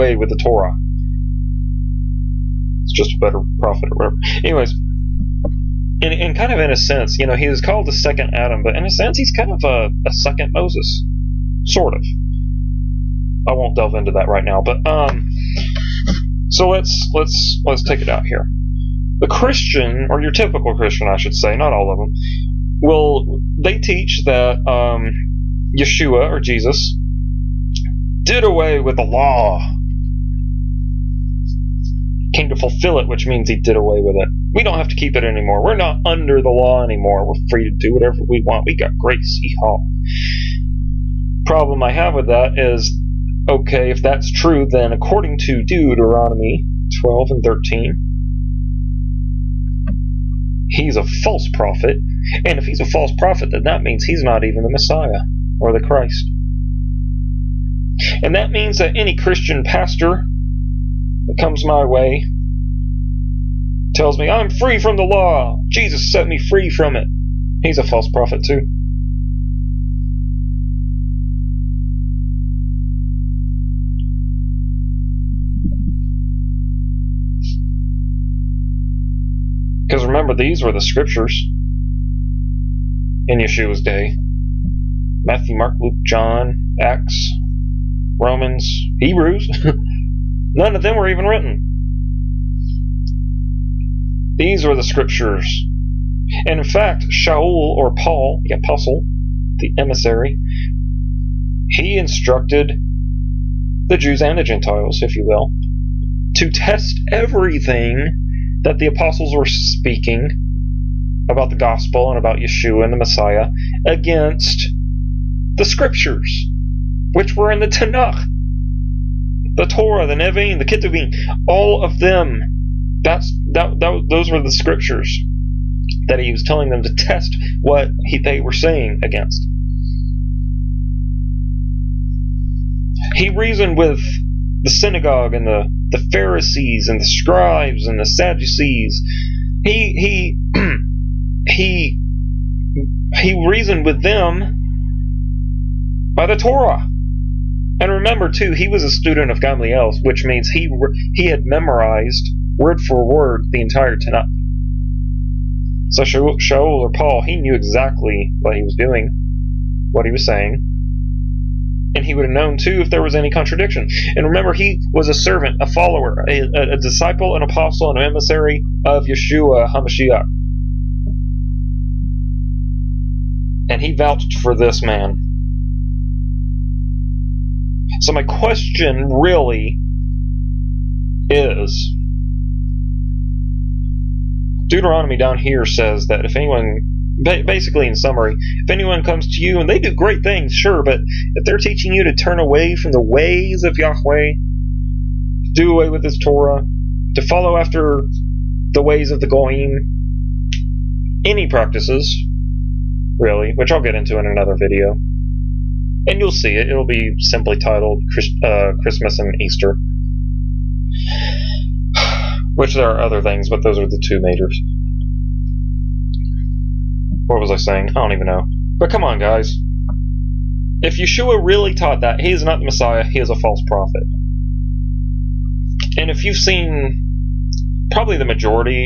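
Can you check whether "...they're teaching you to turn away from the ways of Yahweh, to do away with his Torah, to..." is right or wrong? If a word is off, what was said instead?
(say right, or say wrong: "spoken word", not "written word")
right.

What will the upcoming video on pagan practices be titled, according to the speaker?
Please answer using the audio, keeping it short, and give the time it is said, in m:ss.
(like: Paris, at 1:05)
Christmas and Easter, at 3:28.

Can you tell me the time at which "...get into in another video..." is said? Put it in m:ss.
3:23.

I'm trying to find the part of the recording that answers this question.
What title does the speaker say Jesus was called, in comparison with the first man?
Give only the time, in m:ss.
0:07.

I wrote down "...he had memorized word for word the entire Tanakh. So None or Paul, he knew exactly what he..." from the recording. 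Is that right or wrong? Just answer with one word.
wrong.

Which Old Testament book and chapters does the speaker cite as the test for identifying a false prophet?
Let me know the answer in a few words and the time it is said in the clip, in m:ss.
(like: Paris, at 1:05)
Deuteronomy 12 and 13, at 0:45.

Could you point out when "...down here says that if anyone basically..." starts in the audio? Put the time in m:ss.
3:05.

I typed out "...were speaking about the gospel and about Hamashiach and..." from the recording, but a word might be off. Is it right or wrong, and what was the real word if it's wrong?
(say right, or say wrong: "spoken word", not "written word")
wrong: "Yeshua", not "Hamashiach".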